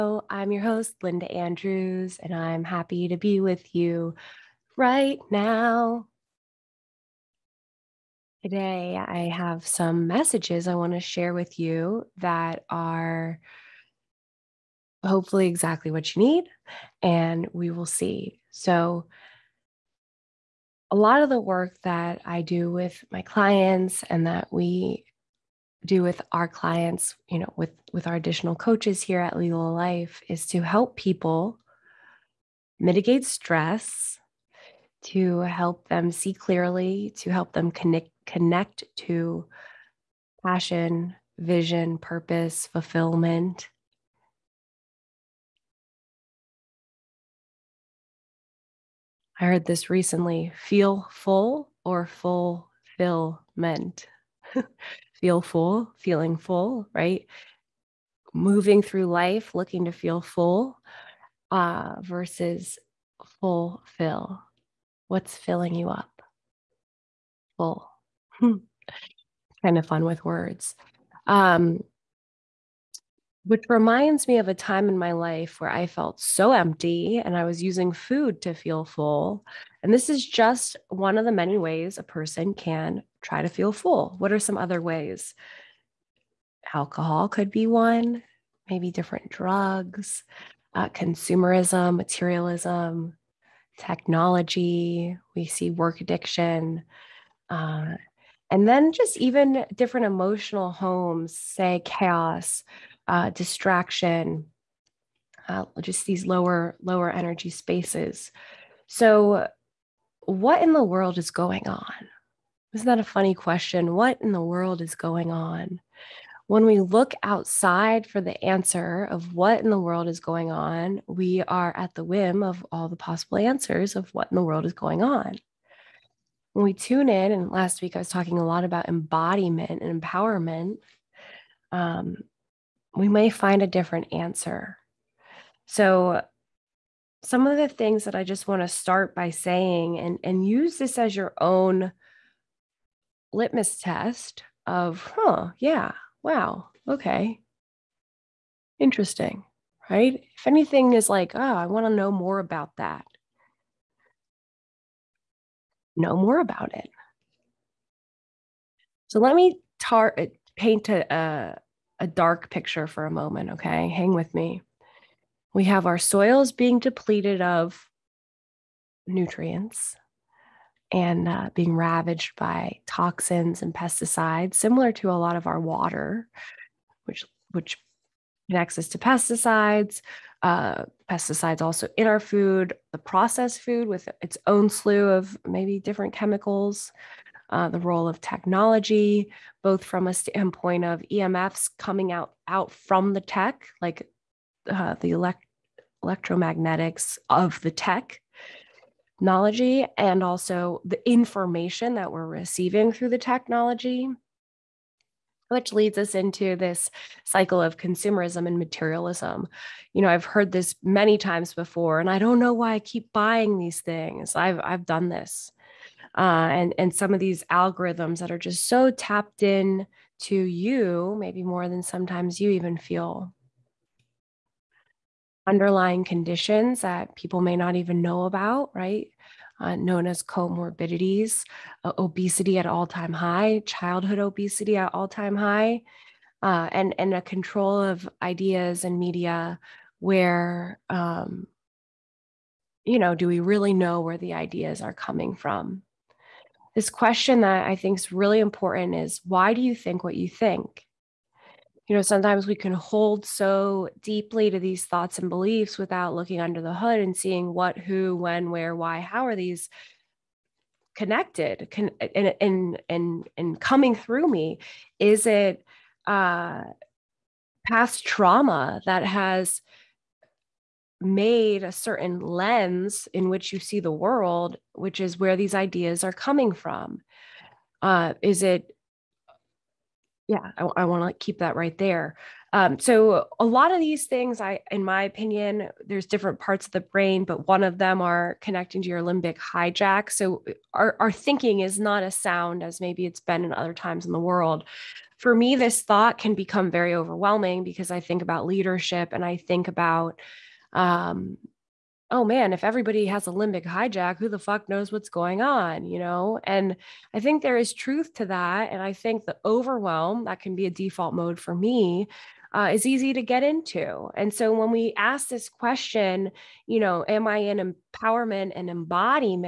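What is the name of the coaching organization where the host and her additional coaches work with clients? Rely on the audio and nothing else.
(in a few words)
Lila Life.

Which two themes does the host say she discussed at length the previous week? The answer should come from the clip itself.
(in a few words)
embodiment and empowerment.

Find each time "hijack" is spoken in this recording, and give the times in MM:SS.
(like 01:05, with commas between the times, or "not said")
04:49, 05:03.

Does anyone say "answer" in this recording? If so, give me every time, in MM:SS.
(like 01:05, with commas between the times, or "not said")
01:58, 02:03, 02:14.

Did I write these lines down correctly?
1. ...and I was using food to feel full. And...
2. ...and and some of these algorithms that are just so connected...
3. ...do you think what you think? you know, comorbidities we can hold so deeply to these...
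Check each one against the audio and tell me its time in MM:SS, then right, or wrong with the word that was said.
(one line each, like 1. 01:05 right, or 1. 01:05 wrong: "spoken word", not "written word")
1. 01:17 right
2. 03:36 wrong: "tapped", not "connected"
3. 04:09 wrong: "sometimes", not "comorbidities".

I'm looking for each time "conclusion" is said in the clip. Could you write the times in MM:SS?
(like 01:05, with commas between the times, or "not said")
not said.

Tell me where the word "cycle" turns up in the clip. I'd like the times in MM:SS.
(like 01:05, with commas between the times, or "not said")
03:27.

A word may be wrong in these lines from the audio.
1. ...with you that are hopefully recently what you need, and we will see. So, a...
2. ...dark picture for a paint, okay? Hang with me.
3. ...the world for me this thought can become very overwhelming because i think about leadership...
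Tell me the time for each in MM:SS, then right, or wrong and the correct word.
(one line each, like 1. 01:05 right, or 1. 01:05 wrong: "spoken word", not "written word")
1. 00:11 wrong: "exactly", not "recently"
2. 02:42 wrong: "moment", not "paint"
3. 04:54 right.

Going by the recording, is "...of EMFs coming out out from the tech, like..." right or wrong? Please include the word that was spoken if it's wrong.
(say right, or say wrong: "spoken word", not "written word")
right.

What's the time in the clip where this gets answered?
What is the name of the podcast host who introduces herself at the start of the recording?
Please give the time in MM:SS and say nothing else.
00:01.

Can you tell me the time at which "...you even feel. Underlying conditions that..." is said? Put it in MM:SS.
03:42.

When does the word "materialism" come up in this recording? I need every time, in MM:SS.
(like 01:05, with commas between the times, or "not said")
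01:31, 03:28.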